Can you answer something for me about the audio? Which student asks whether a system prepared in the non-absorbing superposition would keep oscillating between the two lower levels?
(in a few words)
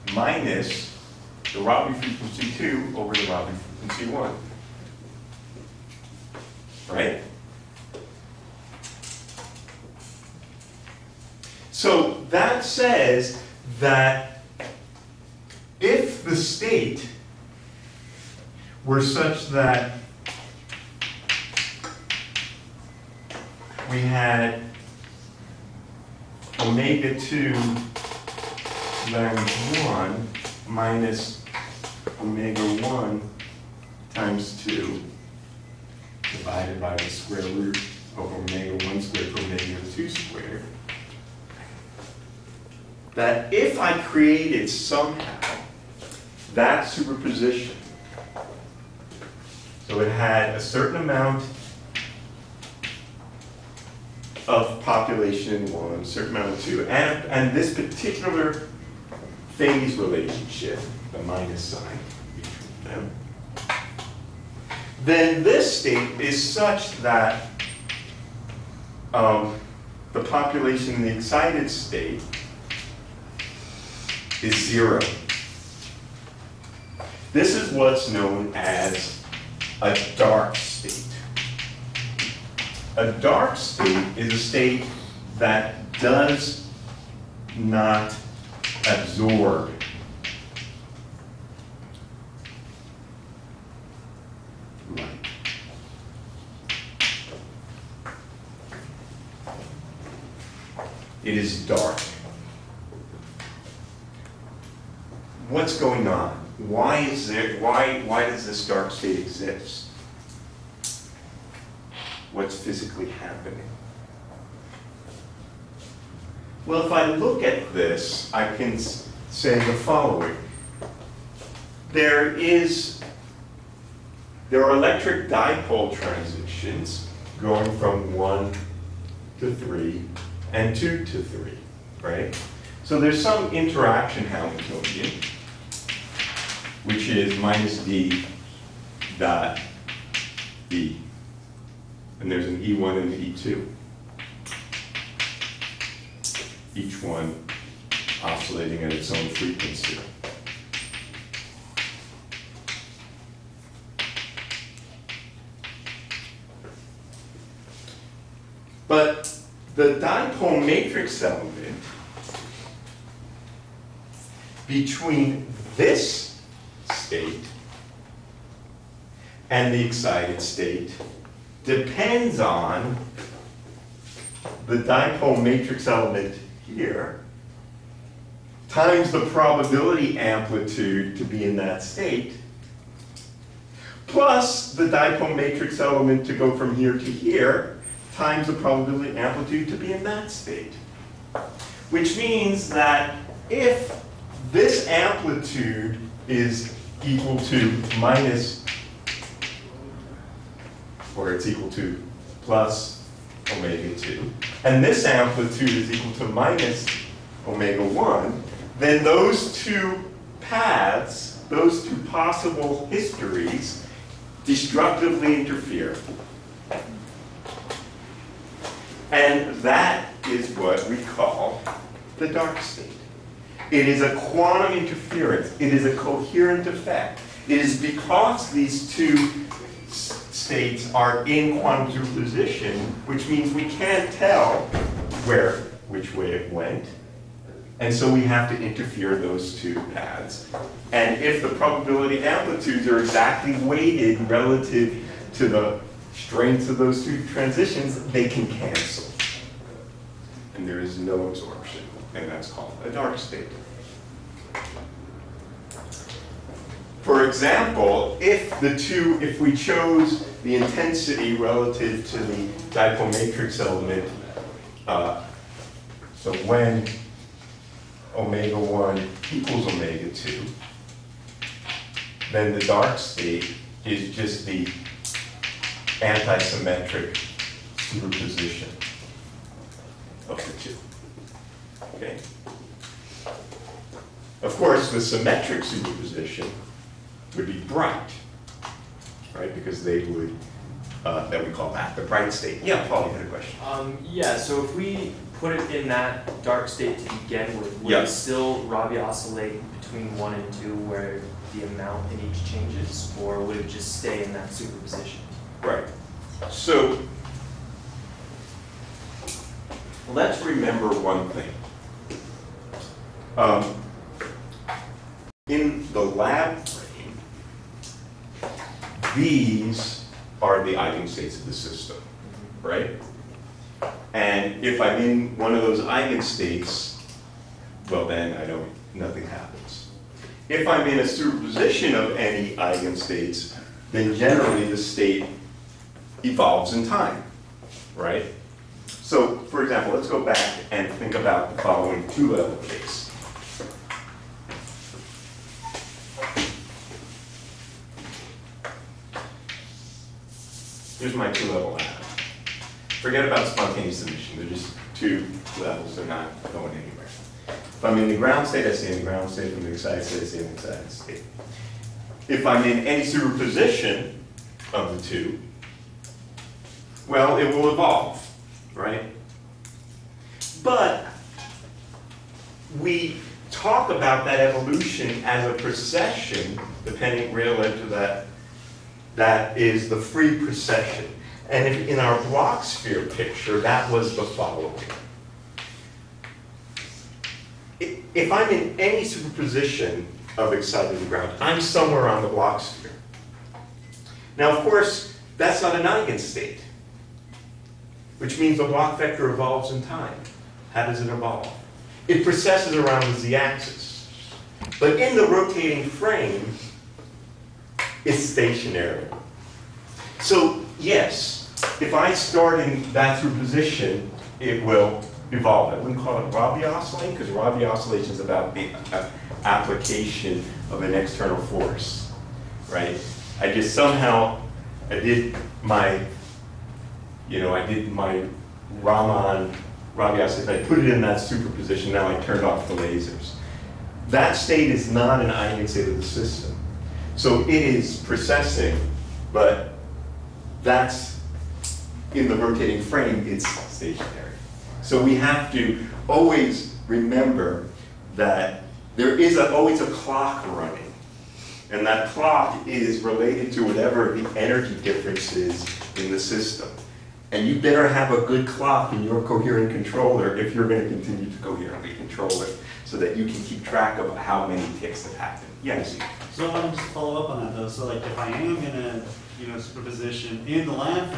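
Paul.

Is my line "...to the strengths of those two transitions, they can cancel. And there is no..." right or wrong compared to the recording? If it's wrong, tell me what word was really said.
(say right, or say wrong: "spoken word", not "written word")
right.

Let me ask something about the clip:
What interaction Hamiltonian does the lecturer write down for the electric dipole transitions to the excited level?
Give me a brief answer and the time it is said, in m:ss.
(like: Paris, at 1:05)
minus d dot e, at 2:17.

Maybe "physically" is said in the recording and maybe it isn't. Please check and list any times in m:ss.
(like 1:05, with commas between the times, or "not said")
1:52.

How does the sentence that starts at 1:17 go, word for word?
This is what's known as a dark state.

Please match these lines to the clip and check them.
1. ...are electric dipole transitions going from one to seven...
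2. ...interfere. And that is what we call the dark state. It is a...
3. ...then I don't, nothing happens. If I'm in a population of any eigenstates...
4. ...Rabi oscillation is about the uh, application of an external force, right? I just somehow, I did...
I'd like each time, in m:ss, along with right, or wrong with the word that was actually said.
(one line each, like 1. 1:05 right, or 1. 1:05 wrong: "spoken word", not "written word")
1. 2:04 wrong: "three", not "seven"
2. 3:35 right
3. 5:28 wrong: "superposition", not "population"
4. 6:57 right.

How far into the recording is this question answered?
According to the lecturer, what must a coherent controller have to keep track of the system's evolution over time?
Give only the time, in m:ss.
7:38.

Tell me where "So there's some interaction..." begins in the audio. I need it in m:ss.
2:12.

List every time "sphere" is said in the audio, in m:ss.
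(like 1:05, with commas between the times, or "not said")
6:22, 6:32.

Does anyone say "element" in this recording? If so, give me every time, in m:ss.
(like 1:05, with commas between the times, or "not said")
2:41, 2:55, 3:05, 4:23.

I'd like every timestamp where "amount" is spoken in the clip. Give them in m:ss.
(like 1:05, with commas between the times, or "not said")
0:51, 0:56, 5:01.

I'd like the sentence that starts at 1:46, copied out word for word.
Why is there, why, why does this dark state exist?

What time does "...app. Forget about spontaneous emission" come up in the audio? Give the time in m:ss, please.
5:51.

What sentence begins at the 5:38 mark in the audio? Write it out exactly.
So, for example, let's go back and think about the following two-level case.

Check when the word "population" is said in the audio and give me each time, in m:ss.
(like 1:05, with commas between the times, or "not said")
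0:54, 1:10.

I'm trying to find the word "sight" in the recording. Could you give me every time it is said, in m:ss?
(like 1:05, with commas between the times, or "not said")
not said.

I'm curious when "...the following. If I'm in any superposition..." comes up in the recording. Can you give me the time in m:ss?
6:24.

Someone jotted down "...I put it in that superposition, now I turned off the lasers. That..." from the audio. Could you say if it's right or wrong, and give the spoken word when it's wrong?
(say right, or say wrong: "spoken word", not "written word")
right.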